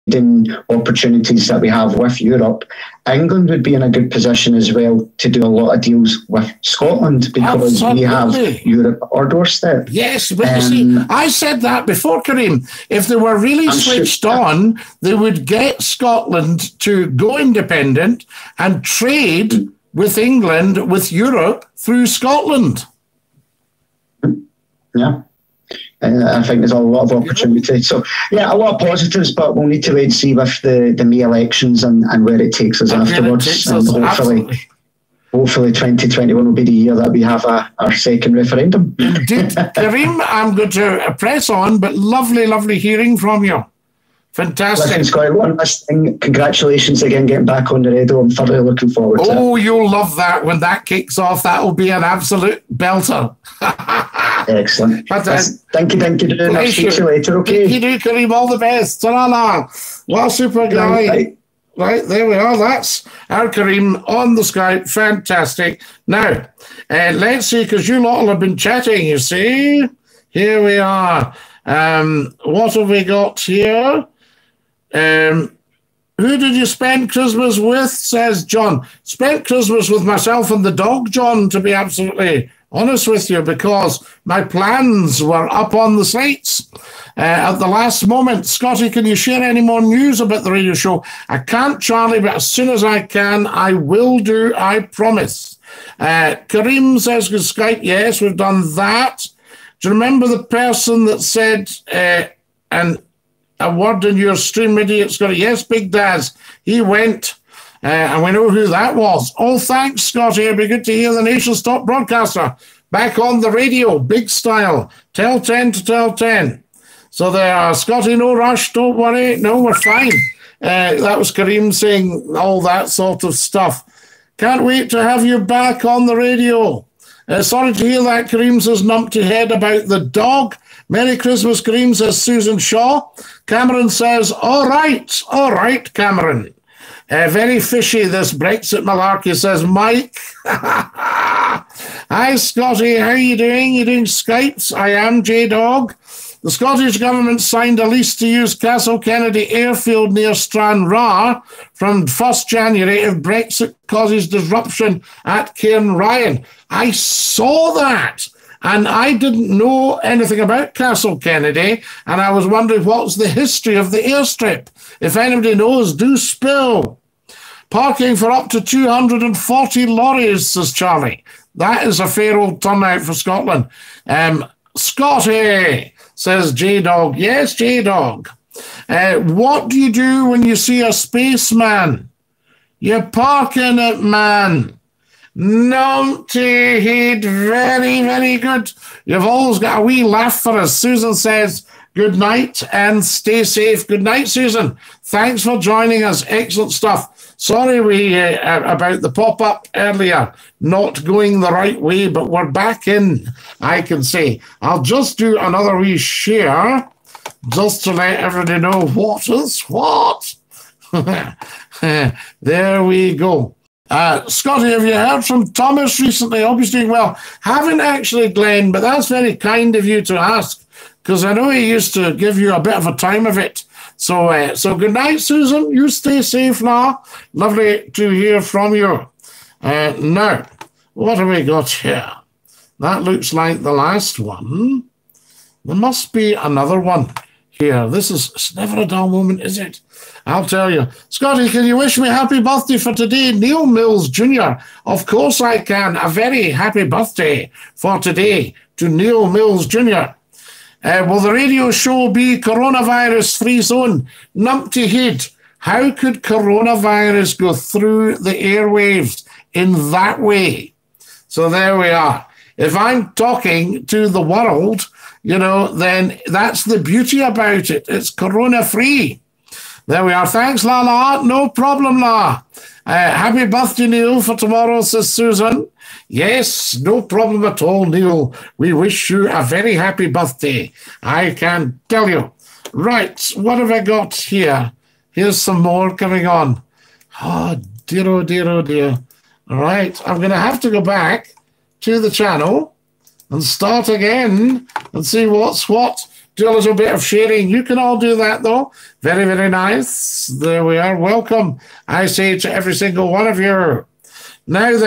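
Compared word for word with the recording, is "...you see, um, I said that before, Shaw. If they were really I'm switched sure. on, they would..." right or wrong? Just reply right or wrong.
wrong.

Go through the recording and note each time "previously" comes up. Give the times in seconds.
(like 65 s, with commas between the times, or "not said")
not said.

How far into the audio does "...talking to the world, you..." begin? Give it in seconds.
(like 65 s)
263 s.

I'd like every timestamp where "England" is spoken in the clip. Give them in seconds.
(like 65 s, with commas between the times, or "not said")
3 s, 20 s.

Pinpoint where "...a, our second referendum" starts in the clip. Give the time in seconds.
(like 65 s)
37 s.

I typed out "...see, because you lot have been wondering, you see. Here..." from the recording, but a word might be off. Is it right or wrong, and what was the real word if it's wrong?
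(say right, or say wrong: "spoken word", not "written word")
wrong: "chatting", not "wondering".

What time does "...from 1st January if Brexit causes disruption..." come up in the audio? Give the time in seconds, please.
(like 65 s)
151 s.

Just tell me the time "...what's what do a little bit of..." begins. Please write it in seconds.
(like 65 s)
295 s.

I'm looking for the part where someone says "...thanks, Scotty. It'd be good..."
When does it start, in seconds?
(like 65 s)
109 s.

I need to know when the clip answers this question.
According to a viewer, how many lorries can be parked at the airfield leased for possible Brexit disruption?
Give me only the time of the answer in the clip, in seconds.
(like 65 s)
168 s.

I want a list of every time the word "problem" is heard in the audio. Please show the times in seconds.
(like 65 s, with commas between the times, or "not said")
271 s, 277 s.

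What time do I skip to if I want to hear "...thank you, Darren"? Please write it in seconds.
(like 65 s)
55 s.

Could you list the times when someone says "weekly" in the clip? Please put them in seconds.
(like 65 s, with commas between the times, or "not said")
not said.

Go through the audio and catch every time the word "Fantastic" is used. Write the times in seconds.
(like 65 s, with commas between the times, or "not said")
44 s, 64 s.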